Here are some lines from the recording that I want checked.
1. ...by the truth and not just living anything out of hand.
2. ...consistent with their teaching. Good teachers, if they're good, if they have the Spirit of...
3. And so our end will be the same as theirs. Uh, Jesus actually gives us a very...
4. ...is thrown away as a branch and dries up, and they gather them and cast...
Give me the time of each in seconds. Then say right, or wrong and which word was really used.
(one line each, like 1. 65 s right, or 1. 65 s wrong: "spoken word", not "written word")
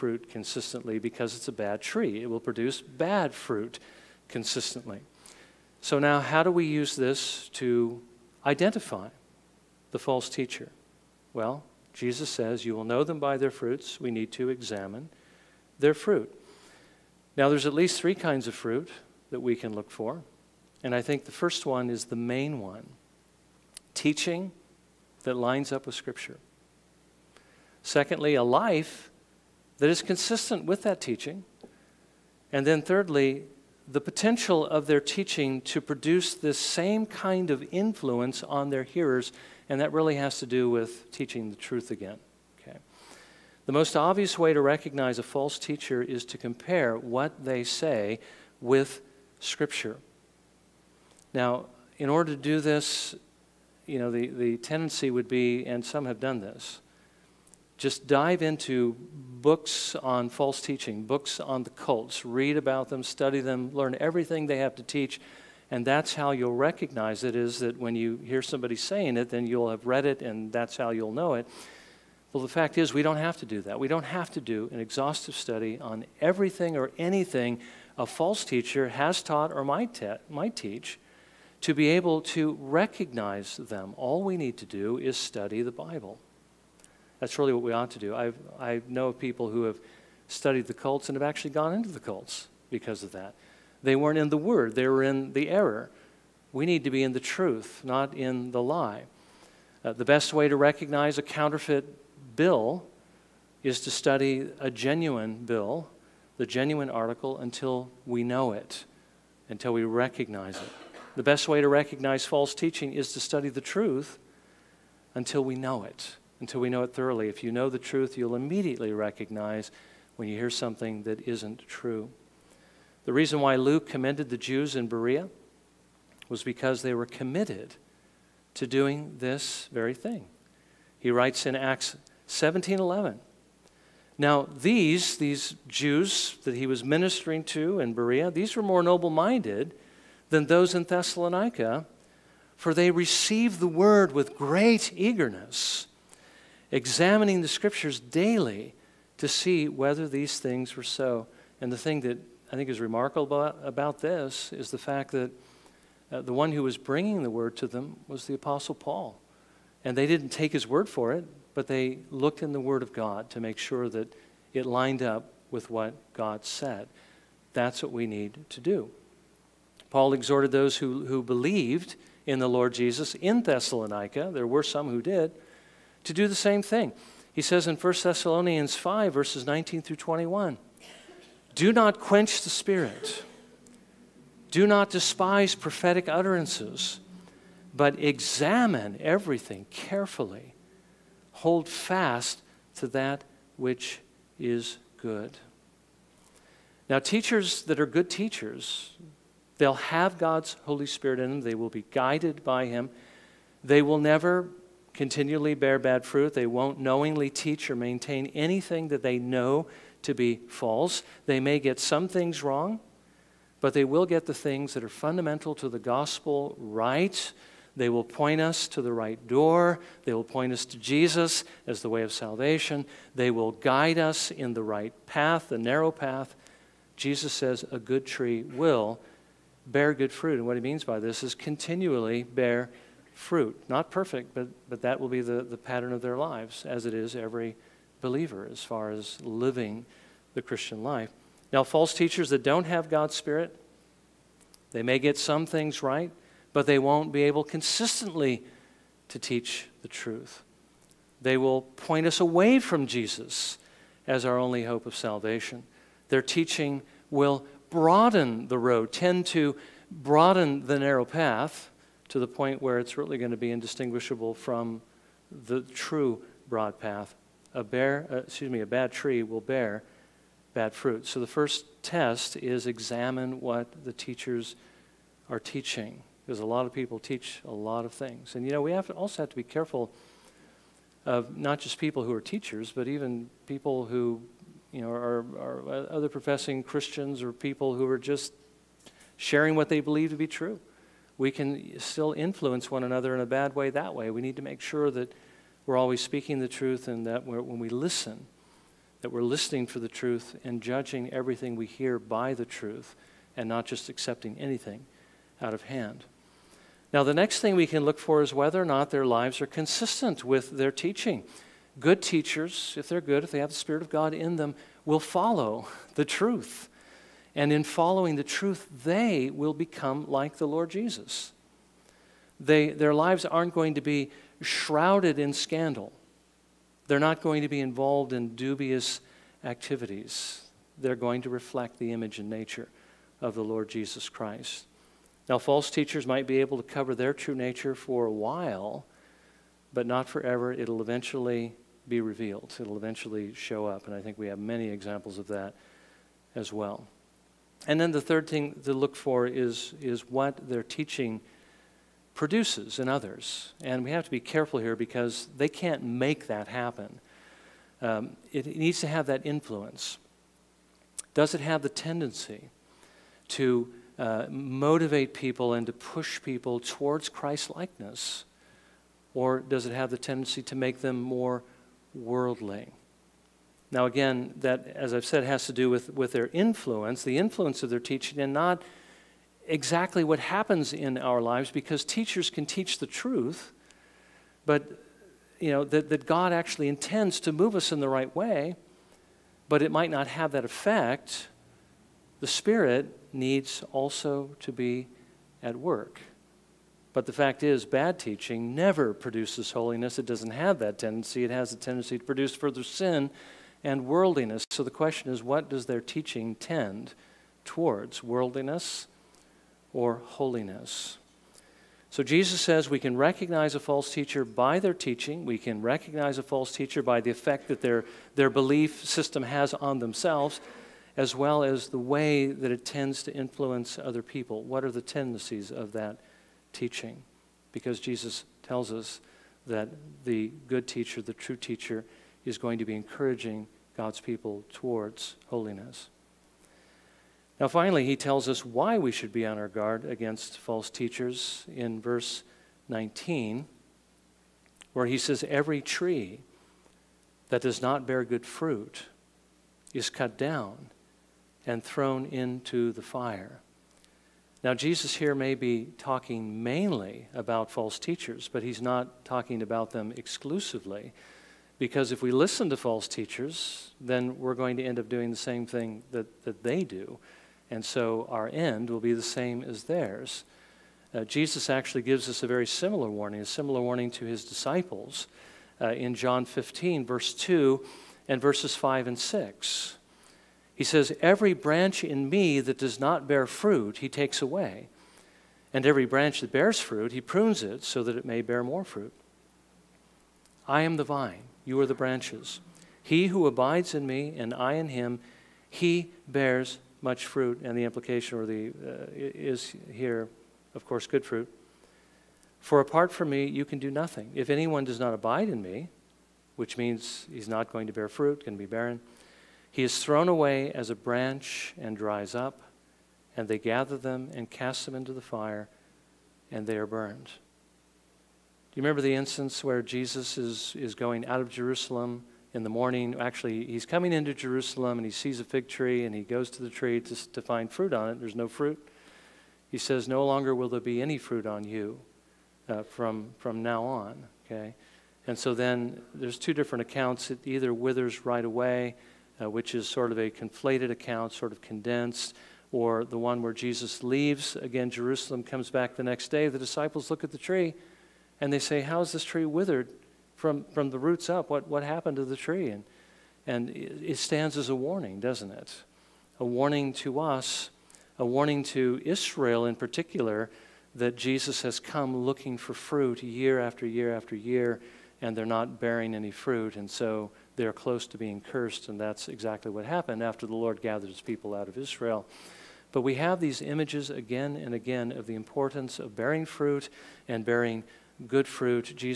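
1. 301 s wrong: "accepting", not "living"
2. 309 s right
3. 467 s right
4. 509 s right.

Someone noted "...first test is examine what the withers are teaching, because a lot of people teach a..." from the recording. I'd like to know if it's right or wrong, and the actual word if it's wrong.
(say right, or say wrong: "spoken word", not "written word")
wrong: "teachers", not "withers".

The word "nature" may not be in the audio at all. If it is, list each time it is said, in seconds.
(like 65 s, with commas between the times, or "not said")
332 s, 337 s.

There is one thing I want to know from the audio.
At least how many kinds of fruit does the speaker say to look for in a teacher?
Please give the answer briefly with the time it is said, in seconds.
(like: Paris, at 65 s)
3, at 18 s.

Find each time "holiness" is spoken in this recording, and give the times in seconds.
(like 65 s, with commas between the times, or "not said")
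399 s, 410 s, 435 s.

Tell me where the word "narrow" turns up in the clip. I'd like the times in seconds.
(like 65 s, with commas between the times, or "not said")
225 s, 260 s.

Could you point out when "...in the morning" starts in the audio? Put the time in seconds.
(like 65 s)
522 s.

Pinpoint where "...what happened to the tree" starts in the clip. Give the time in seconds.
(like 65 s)
551 s.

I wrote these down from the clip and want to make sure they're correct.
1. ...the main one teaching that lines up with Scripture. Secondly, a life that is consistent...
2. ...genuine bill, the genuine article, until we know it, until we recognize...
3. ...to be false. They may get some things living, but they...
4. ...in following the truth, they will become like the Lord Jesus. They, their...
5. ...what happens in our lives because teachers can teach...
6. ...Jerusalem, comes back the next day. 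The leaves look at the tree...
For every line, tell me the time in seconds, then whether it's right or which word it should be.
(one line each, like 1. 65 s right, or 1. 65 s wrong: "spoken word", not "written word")
1. 22 s right
2. 104 s right
3. 210 s wrong: "wrong", not "living"
4. 317 s right
5. 380 s right
6. 544 s wrong: "disciples", not "leaves".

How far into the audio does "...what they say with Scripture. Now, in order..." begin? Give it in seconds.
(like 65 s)
46 s.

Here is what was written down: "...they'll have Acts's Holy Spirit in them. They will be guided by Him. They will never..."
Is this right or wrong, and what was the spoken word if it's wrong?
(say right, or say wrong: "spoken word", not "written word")
wrong: "God", not "Acts".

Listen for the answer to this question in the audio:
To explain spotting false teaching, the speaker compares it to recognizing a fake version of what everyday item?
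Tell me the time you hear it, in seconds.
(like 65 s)
101 s.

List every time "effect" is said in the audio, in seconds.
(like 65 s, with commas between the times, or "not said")
390 s, 417 s.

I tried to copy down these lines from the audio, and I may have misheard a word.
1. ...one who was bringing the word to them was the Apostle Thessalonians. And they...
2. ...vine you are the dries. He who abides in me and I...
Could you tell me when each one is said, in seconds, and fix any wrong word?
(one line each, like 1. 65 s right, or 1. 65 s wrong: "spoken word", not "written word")
1. 156 s wrong: "Paul", not "Thessalonians"
2. 490 s wrong: "branches", not "dries".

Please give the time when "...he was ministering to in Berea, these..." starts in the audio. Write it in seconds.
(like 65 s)
136 s.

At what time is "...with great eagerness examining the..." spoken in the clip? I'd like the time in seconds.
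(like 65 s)
144 s.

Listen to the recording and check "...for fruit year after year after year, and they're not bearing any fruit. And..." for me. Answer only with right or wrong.
right.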